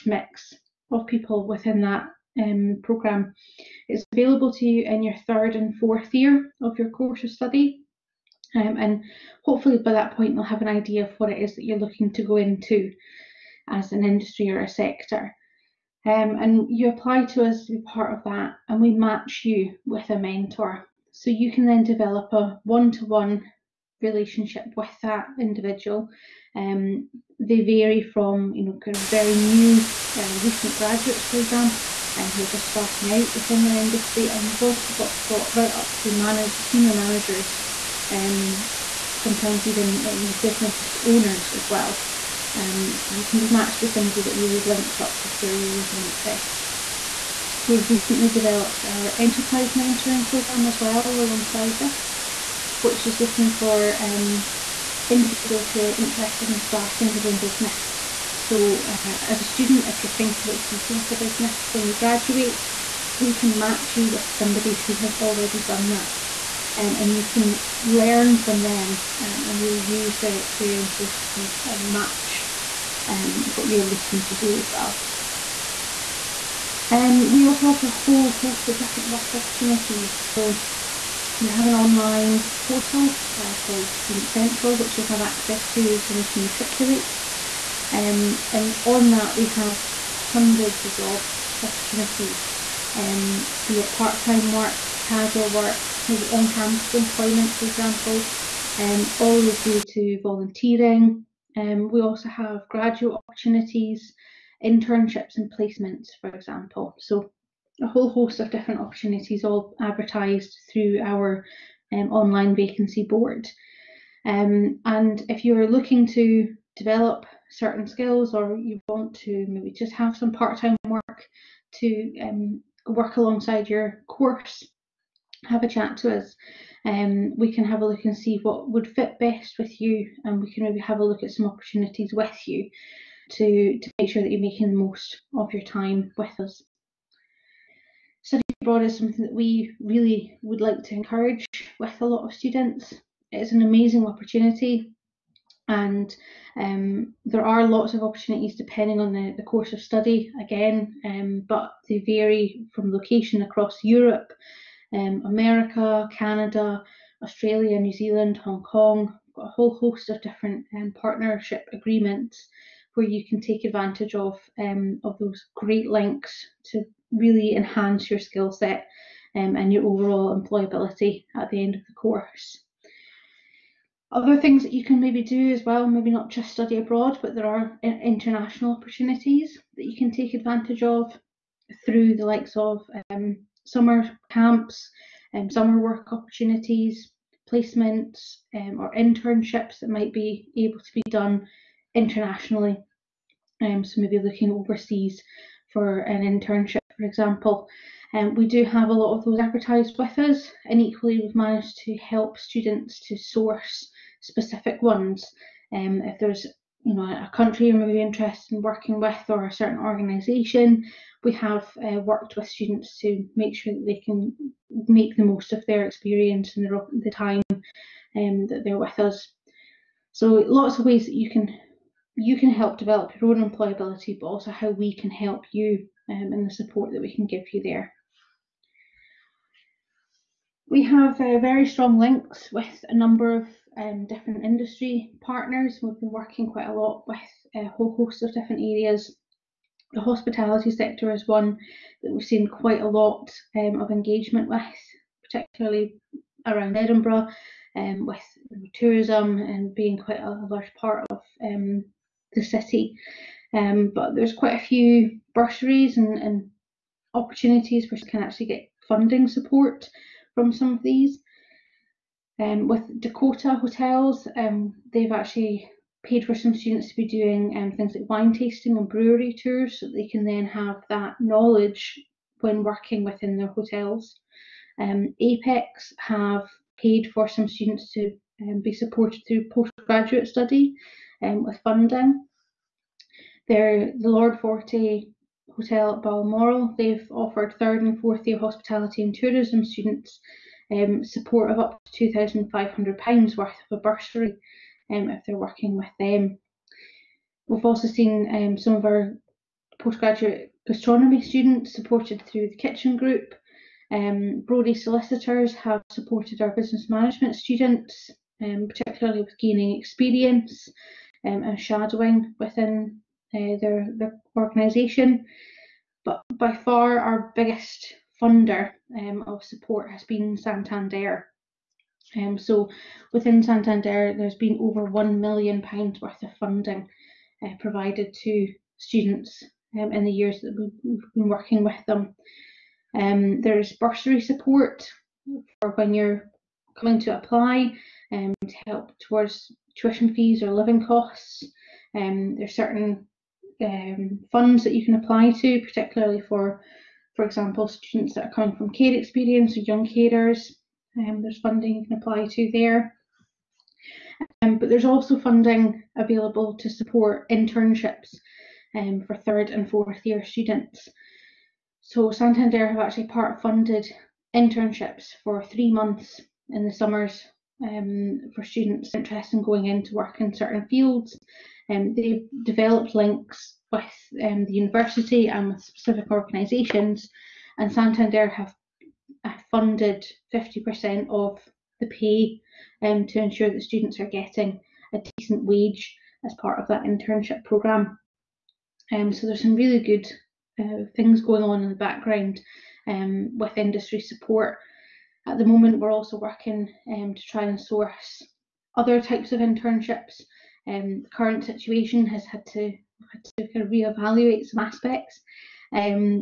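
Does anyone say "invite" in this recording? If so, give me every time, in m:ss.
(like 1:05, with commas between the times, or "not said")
not said.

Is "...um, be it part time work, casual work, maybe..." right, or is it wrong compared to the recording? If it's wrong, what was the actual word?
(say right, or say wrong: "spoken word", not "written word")
right.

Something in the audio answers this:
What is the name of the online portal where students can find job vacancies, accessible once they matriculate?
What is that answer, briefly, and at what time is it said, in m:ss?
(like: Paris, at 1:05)
Student Central, at 1:23.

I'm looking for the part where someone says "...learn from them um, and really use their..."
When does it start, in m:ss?
1:07.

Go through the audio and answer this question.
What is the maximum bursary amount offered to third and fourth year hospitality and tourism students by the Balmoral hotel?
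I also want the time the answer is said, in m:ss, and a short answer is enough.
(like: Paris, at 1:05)
£2,500, at 4:52.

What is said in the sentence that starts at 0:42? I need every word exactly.
Um, so you can be matched with somebody that really links up with your areas of interest.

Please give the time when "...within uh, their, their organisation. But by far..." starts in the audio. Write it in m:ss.
5:12.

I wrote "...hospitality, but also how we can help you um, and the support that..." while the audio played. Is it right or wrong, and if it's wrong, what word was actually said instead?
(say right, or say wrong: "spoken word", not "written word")
wrong: "employability", not "hospitality".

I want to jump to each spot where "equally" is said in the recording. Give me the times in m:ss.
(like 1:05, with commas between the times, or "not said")
3:20.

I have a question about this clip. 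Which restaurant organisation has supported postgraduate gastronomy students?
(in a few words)
The Kitchin Group.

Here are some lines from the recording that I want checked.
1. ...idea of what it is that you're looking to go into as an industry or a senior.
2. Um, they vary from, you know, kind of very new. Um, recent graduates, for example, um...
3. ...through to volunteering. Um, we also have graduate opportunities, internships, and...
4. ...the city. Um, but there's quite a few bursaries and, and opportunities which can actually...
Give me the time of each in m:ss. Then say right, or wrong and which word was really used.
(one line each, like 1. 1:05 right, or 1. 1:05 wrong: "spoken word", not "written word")
1. 0:10 wrong: "sector", not "senior"
2. 0:26 right
3. 1:39 right
4. 4:12 right.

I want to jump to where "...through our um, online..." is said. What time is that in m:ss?
1:50.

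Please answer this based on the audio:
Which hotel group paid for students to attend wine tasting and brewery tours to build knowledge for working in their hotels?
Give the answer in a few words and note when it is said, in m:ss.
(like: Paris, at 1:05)
Dakota Hotels, at 4:22.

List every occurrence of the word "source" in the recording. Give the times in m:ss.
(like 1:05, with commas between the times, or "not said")
3:23, 6:37.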